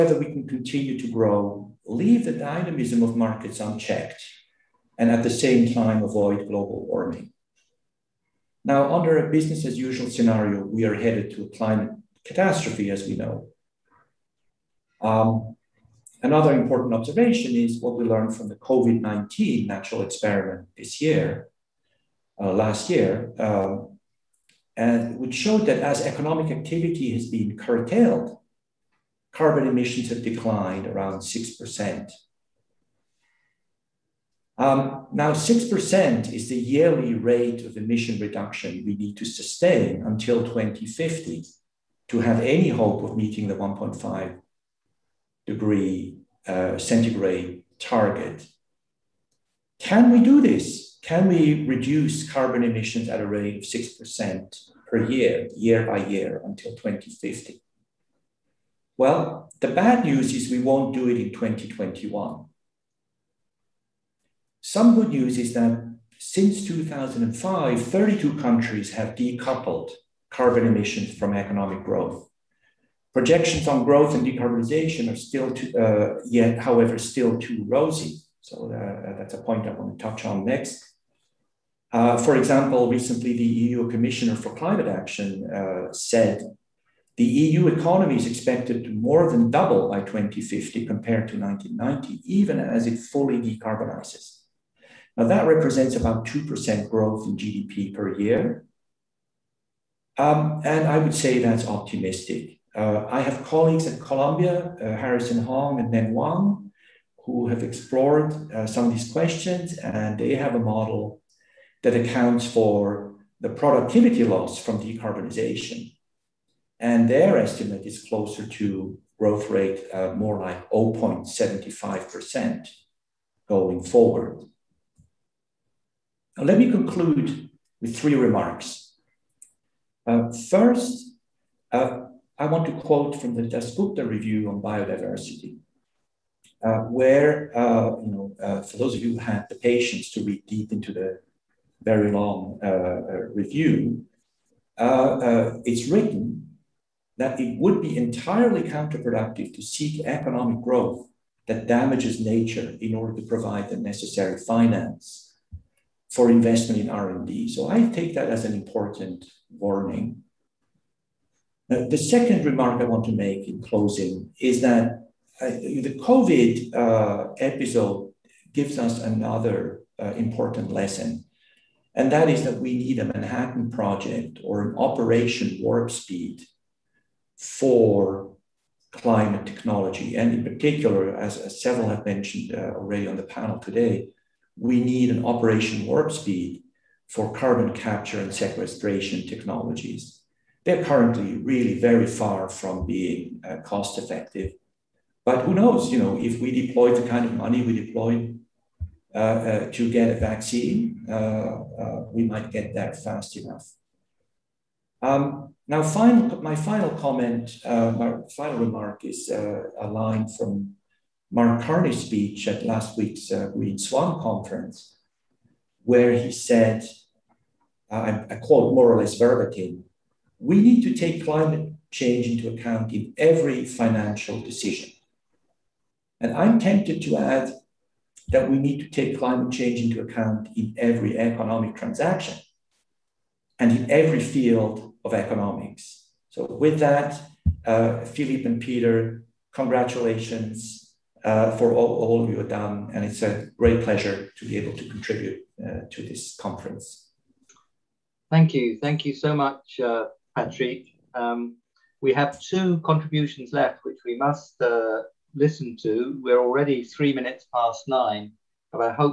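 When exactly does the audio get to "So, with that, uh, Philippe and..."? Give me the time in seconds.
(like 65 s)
236 s.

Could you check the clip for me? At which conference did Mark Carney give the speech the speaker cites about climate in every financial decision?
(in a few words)
Green Swan conference.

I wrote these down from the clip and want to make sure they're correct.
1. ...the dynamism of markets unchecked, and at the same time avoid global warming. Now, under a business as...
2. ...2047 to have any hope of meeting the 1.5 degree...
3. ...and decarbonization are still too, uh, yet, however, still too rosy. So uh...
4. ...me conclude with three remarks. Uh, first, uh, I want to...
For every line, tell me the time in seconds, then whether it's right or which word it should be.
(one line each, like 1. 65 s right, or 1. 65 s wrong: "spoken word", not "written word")
1. 2 s right
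2. 40 s wrong: "2050", not "2047"
3. 74 s right
4. 126 s right.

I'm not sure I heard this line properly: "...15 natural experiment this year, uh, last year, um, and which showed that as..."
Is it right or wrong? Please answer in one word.
wrong.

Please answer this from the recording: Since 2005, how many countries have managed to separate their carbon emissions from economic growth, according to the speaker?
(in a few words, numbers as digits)
32.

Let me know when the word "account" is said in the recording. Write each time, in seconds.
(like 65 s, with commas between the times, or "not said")
111 s, 222 s, 230 s.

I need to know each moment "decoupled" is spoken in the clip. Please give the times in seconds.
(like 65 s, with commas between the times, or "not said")
69 s.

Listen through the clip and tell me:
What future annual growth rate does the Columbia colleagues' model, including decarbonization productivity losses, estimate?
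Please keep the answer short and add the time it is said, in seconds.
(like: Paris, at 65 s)
0.75%, at 120 s.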